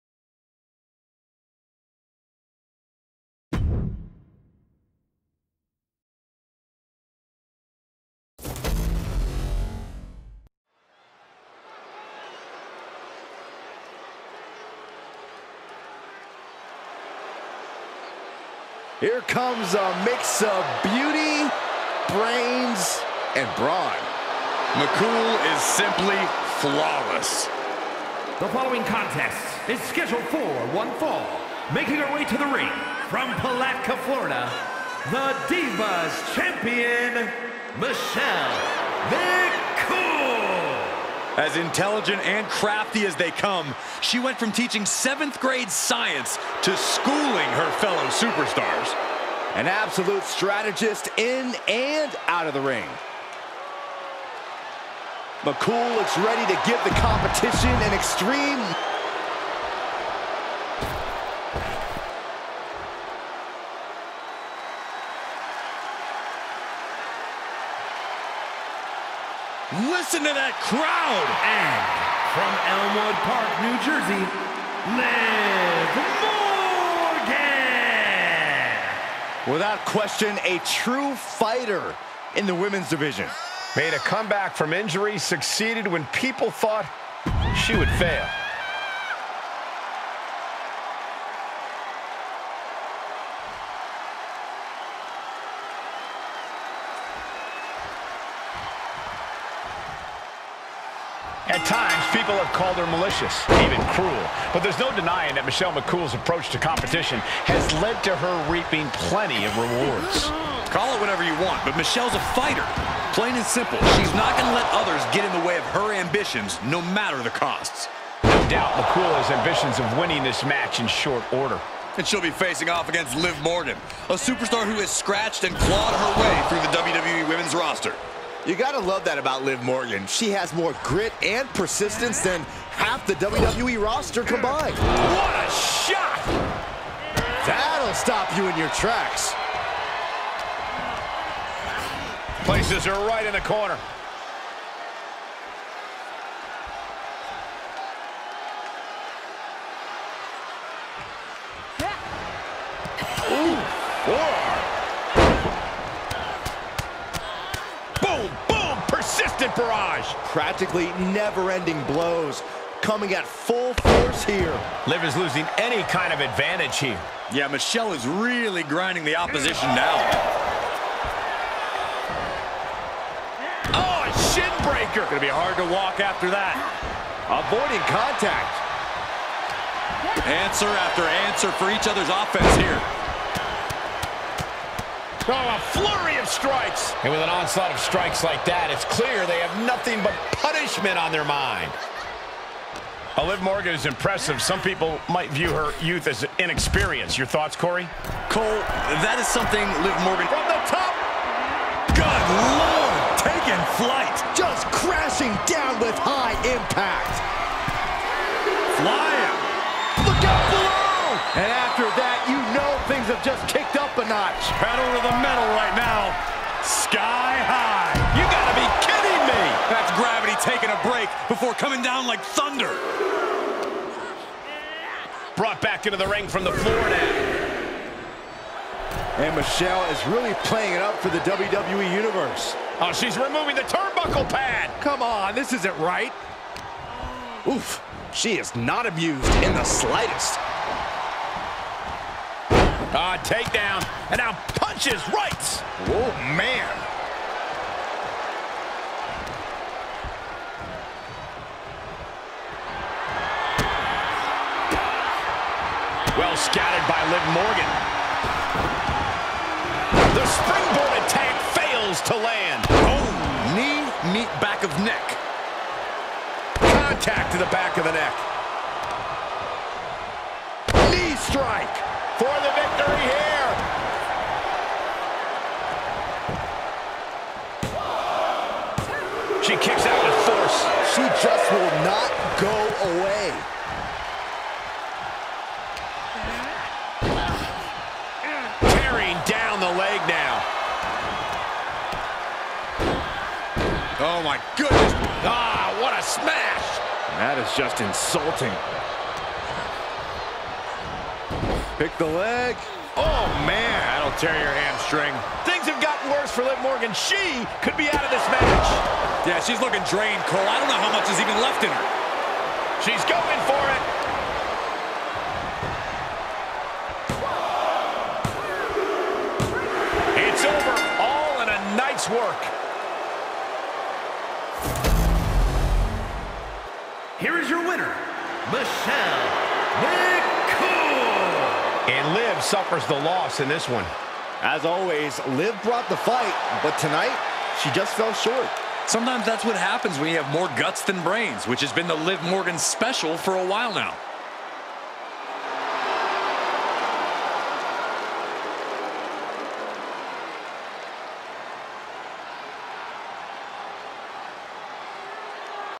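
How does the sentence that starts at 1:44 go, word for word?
But there's no denying that Michelle McCool's approach to competition has led to her reaping plenty of rewards.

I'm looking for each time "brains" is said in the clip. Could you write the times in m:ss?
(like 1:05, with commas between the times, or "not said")
0:22, 5:41.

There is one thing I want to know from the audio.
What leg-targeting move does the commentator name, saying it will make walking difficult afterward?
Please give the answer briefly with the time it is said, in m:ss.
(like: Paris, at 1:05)
Shin breaker, at 2:54.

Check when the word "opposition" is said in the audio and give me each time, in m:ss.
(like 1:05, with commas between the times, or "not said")
2:49.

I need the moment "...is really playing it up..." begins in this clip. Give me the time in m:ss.
3:49.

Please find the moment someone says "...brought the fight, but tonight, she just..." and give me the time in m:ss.
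5:35.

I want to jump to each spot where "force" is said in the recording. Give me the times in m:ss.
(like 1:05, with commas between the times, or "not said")
2:43, 4:40.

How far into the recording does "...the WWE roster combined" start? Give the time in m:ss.
2:13.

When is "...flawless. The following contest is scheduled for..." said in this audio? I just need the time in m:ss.
0:26.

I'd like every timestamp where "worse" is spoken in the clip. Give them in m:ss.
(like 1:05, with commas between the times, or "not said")
5:06.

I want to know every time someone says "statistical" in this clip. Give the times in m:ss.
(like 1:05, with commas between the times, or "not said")
not said.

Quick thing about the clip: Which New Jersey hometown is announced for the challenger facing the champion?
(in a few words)
Elmwood Park, New Jersey.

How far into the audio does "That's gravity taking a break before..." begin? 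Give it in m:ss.
3:39.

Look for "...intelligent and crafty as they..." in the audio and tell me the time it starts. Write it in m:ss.
0:41.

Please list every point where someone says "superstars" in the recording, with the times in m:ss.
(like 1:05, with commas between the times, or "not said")
0:48, 2:04.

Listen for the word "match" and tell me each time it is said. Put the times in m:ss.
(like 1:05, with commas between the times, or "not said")
2:00, 5:08.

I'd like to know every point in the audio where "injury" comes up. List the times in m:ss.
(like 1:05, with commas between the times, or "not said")
1:24.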